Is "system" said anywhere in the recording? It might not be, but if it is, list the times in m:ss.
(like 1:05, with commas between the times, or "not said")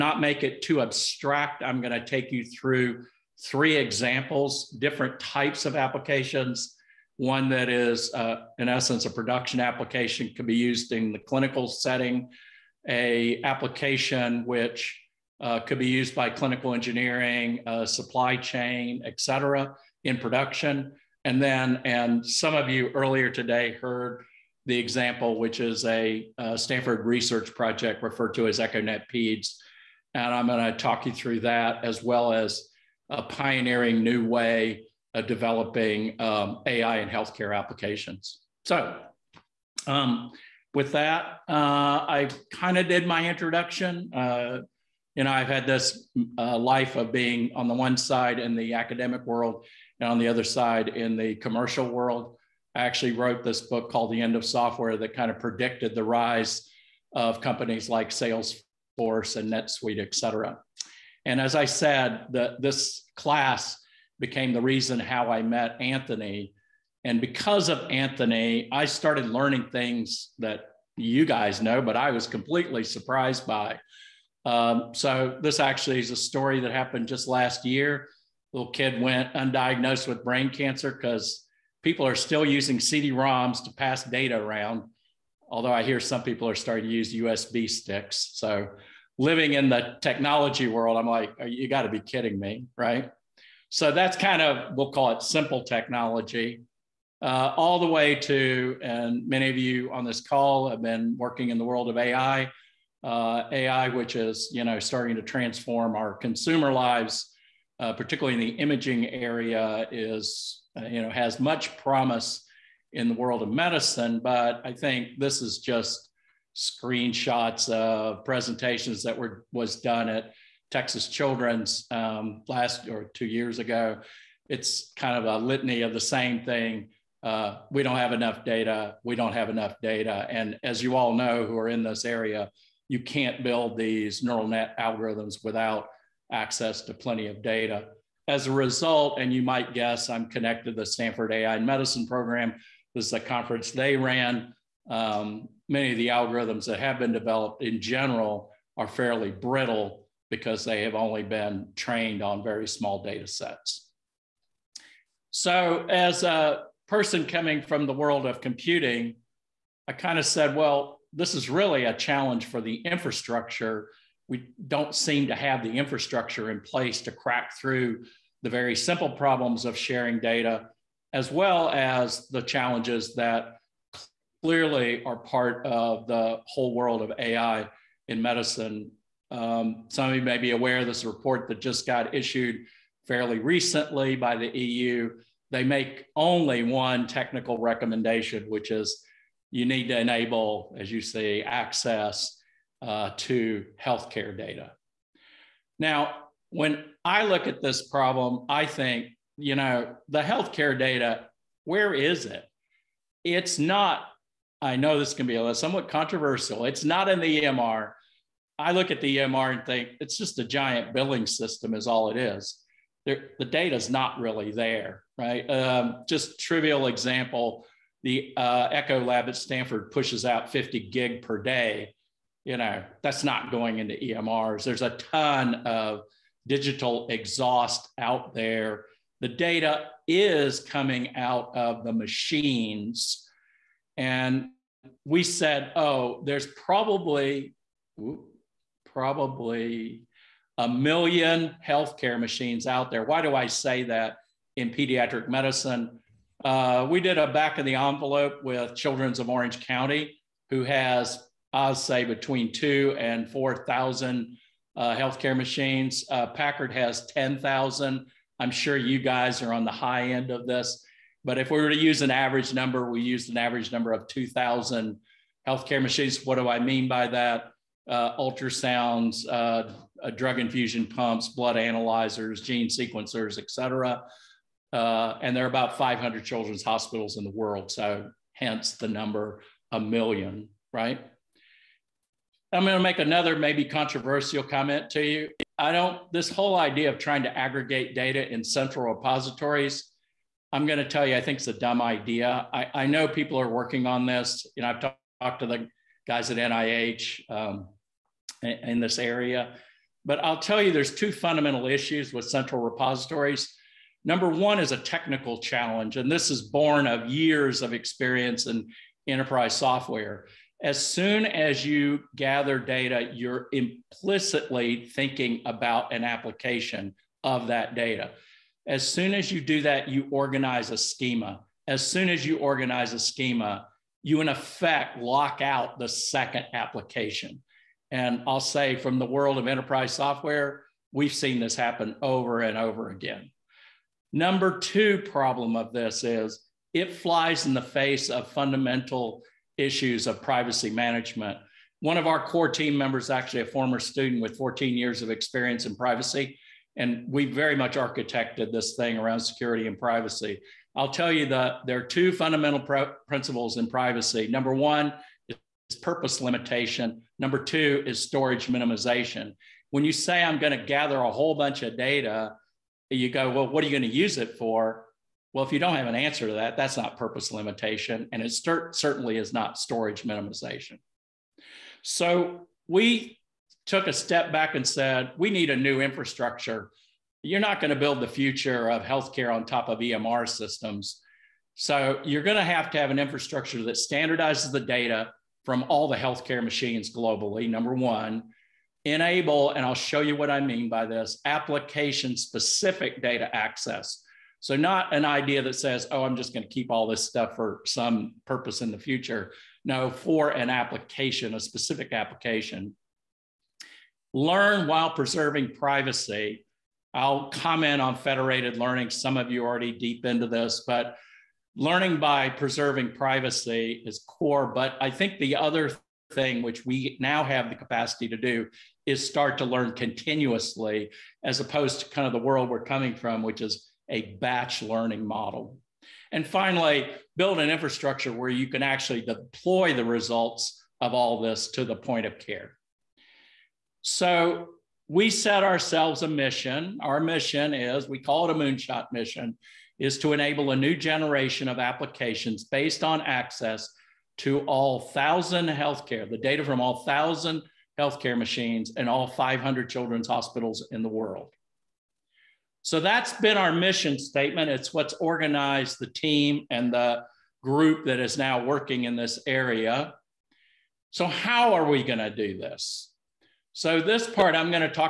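3:31, 6:20.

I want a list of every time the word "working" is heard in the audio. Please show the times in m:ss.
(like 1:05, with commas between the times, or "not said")
1:41, 4:53, 7:38.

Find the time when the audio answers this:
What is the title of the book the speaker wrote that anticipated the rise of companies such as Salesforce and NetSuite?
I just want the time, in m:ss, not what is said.
0:54.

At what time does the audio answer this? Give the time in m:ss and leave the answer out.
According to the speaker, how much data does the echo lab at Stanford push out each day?
3:40.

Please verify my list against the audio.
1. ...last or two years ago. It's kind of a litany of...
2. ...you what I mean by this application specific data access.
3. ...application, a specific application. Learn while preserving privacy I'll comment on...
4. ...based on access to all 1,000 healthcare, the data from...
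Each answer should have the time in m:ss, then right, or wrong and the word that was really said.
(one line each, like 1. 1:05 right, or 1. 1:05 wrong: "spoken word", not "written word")
1. 2:02 right
2. 6:29 right
3. 6:40 right
4. 7:22 right.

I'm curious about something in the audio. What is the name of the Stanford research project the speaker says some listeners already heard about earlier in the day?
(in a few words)
EchoNet PEDS.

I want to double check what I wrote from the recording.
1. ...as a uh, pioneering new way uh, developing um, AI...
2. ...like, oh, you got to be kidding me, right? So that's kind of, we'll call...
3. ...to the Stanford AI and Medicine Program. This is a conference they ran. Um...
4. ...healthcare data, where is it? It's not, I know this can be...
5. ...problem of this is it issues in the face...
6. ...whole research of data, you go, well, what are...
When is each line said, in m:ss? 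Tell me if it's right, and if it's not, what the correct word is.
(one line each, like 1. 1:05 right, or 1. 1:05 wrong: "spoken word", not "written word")
1. 0:32 right
2. 1:31 right
3. 2:20 right
4. 3:20 right
5. 5:35 wrong: "flies", not "issues"
6. 6:01 wrong: "bunch", not "research".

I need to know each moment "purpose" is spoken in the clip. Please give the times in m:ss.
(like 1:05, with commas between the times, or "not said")
5:55, 6:06, 6:38.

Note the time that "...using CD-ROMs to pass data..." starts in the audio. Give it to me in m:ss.
1:22.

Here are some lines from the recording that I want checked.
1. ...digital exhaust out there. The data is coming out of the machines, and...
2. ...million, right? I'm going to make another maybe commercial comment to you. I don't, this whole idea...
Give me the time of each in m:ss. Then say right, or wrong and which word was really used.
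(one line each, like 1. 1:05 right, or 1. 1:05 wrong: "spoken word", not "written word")
1. 3:46 right
2. 4:39 wrong: "controversial", not "commercial".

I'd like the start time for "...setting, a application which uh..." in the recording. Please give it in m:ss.
0:11.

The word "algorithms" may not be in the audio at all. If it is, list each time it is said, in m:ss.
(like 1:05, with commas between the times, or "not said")
2:14, 2:26.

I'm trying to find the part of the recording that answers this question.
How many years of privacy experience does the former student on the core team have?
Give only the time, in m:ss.
5:44.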